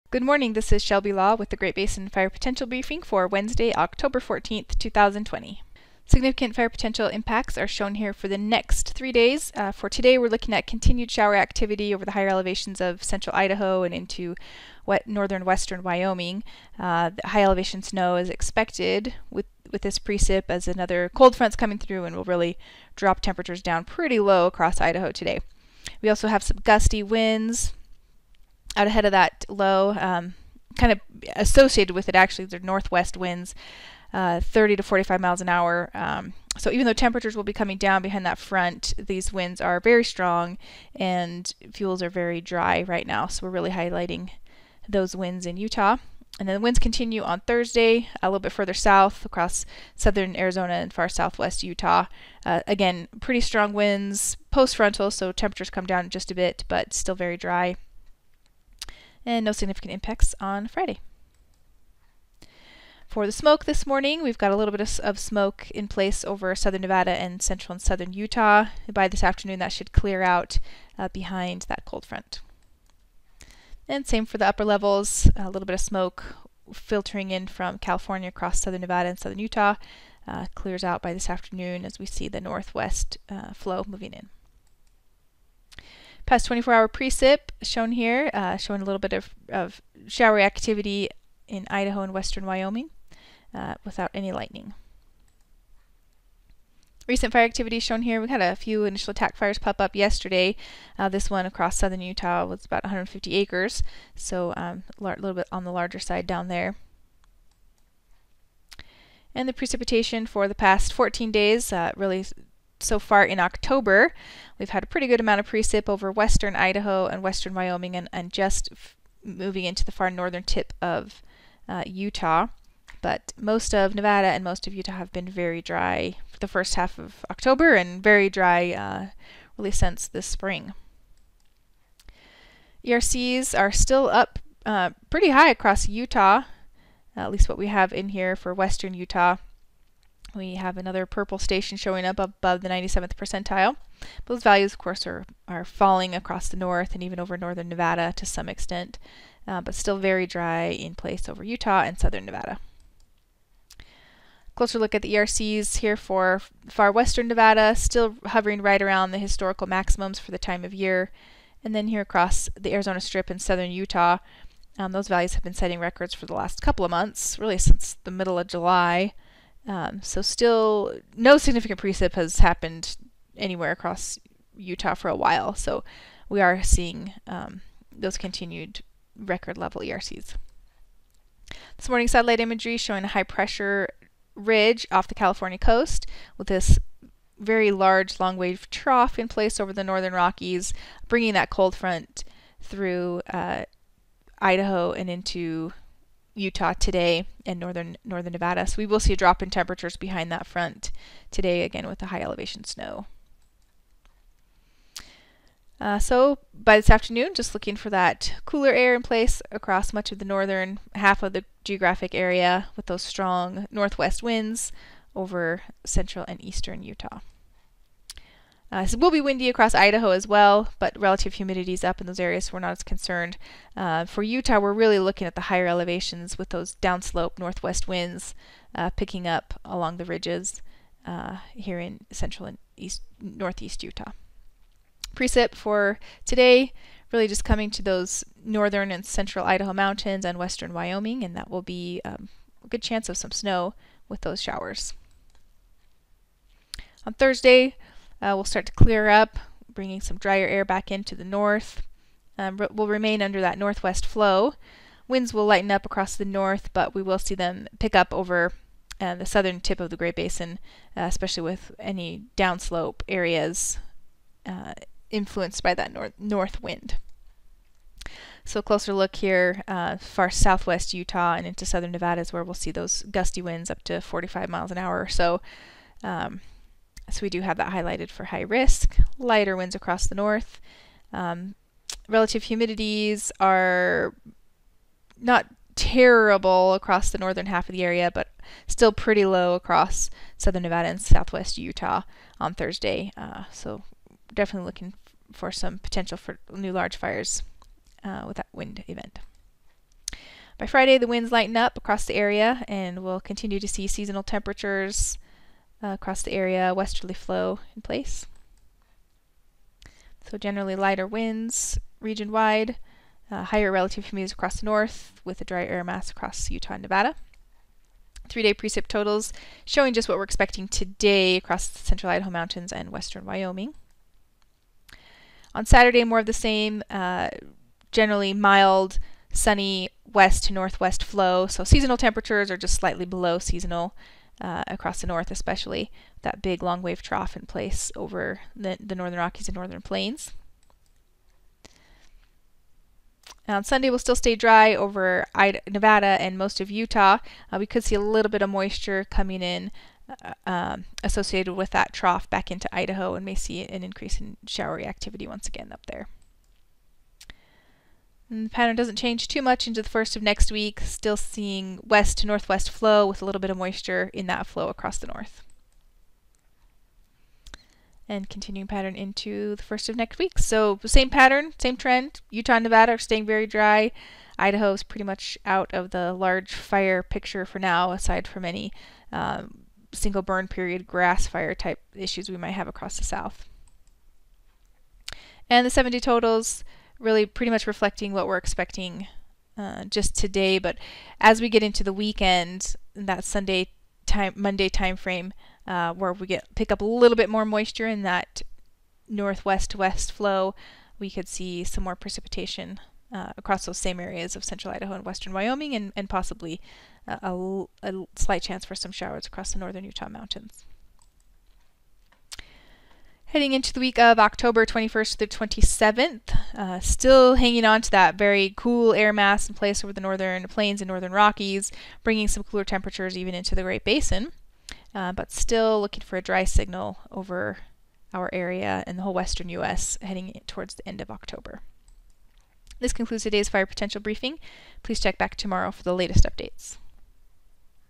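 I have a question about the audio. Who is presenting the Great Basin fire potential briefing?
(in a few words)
Shelby Law.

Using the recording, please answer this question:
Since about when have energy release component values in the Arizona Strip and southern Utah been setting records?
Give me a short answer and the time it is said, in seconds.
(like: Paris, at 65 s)
middle of July, at 168 s.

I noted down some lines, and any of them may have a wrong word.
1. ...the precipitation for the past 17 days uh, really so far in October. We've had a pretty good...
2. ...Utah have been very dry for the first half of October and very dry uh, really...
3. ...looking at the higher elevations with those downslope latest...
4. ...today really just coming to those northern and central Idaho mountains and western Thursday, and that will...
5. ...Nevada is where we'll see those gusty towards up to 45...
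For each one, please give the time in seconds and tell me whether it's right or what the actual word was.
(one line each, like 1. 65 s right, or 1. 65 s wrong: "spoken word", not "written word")
1. 109 s wrong: "14", not "17"
2. 124 s right
3. 224 s wrong: "northwest", not "latest"
4. 236 s wrong: "Wyoming", not "Thursday"
5. 271 s wrong: "winds", not "towards".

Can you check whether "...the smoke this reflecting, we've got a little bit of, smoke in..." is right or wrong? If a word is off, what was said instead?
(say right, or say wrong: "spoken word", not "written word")
wrong: "morning", not "reflecting".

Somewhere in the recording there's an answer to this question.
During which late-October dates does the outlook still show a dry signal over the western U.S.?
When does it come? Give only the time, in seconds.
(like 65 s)
414 s.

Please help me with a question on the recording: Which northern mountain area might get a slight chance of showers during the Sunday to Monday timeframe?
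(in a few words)
northern Utah mountains.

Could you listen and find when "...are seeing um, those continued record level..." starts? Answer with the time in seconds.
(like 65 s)
176 s.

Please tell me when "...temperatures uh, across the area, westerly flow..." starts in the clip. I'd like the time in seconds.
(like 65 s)
304 s.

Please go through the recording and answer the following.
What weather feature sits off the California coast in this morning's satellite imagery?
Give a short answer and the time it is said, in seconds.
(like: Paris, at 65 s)
high pressure ridge, at 183 s.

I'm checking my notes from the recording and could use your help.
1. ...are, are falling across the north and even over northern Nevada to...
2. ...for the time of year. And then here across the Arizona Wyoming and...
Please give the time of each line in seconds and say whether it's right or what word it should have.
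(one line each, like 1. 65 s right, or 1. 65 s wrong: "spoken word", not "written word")
1. 145 s right
2. 160 s wrong: "Strip", not "Wyoming".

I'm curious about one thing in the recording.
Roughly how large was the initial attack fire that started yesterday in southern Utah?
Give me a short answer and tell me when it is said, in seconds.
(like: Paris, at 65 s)
150 acres, at 102 s.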